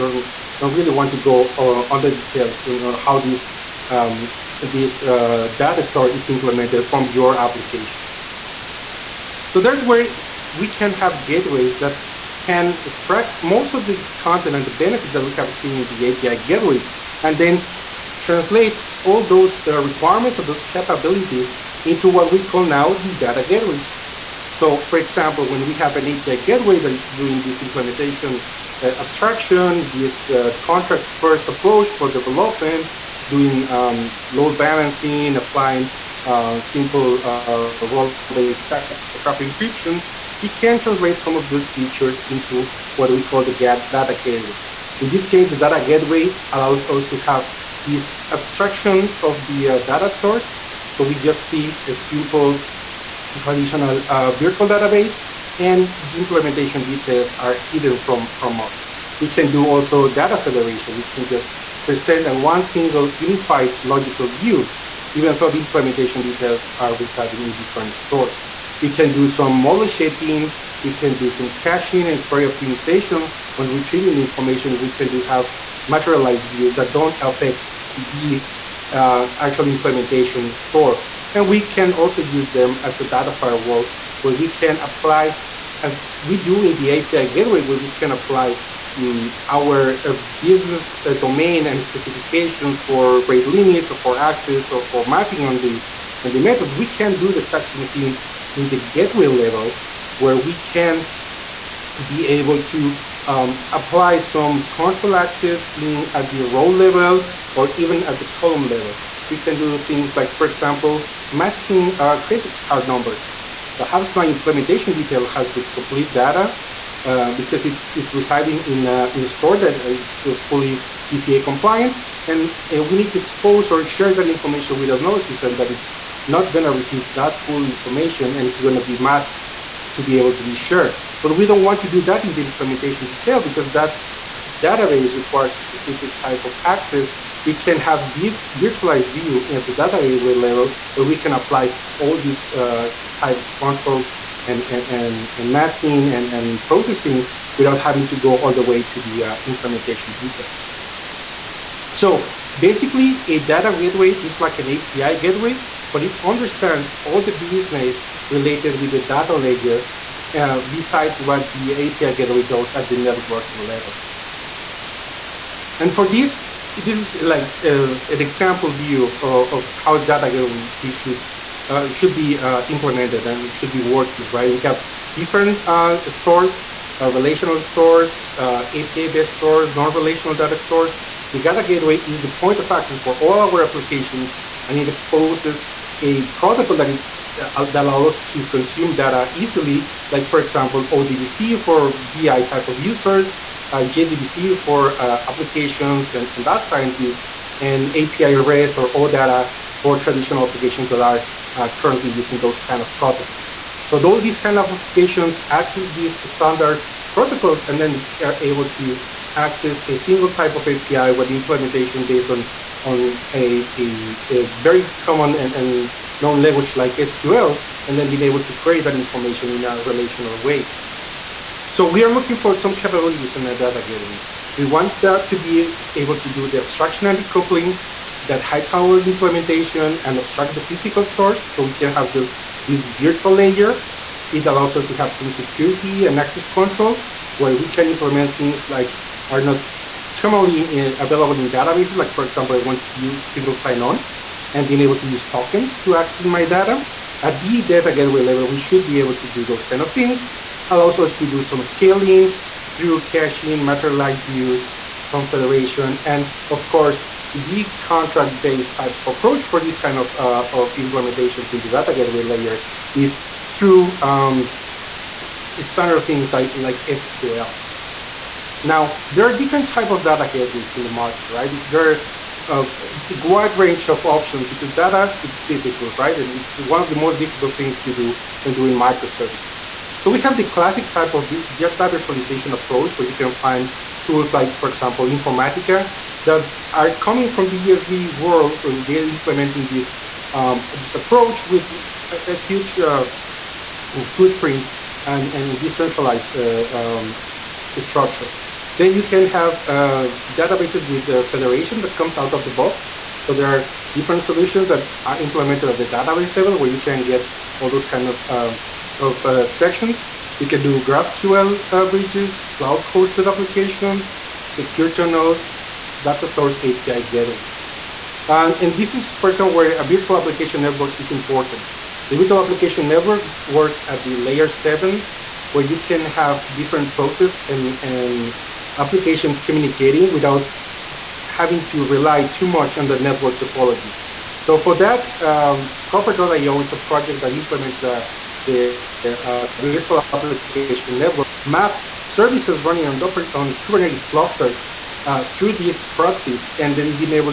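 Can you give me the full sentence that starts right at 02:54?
We have different uh, stores, relational stores, API-based stores, non-relational data stores.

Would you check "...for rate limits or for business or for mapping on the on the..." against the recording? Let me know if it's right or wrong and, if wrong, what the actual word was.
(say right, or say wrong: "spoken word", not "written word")
wrong: "access", not "business".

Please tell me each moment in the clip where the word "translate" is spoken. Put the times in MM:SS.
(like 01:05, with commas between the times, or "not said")
00:18, 00:40.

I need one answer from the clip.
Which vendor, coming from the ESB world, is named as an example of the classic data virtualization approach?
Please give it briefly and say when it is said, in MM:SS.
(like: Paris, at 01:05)
Informatica, at 04:45.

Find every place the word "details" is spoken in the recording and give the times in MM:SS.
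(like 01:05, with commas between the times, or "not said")
00:02, 00:56, 01:06, 01:54, 02:13, 02:30.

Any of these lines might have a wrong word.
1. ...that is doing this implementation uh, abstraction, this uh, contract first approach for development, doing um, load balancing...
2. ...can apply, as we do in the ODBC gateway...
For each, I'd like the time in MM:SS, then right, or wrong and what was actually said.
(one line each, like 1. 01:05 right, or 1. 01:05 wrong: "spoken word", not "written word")
1. 00:26 right
2. 01:24 wrong: "API", not "ODBC".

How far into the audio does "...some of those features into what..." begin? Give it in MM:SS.
00:41.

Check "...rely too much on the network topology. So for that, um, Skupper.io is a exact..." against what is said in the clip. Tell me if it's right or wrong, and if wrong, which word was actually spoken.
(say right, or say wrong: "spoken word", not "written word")
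wrong: "project", not "exact".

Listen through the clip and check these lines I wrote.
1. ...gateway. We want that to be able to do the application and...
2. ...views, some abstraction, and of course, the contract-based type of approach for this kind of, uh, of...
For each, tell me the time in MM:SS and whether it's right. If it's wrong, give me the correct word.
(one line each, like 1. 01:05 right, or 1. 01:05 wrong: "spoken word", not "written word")
1. 03:43 wrong: "abstraction", not "application"
2. 04:14 wrong: "federation", not "abstraction".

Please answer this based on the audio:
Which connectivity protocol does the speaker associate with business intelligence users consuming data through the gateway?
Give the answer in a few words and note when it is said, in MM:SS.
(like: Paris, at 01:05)
ODBC, at 03:10.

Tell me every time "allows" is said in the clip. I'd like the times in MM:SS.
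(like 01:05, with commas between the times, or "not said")
00:46, 03:07, 03:54, 04:10.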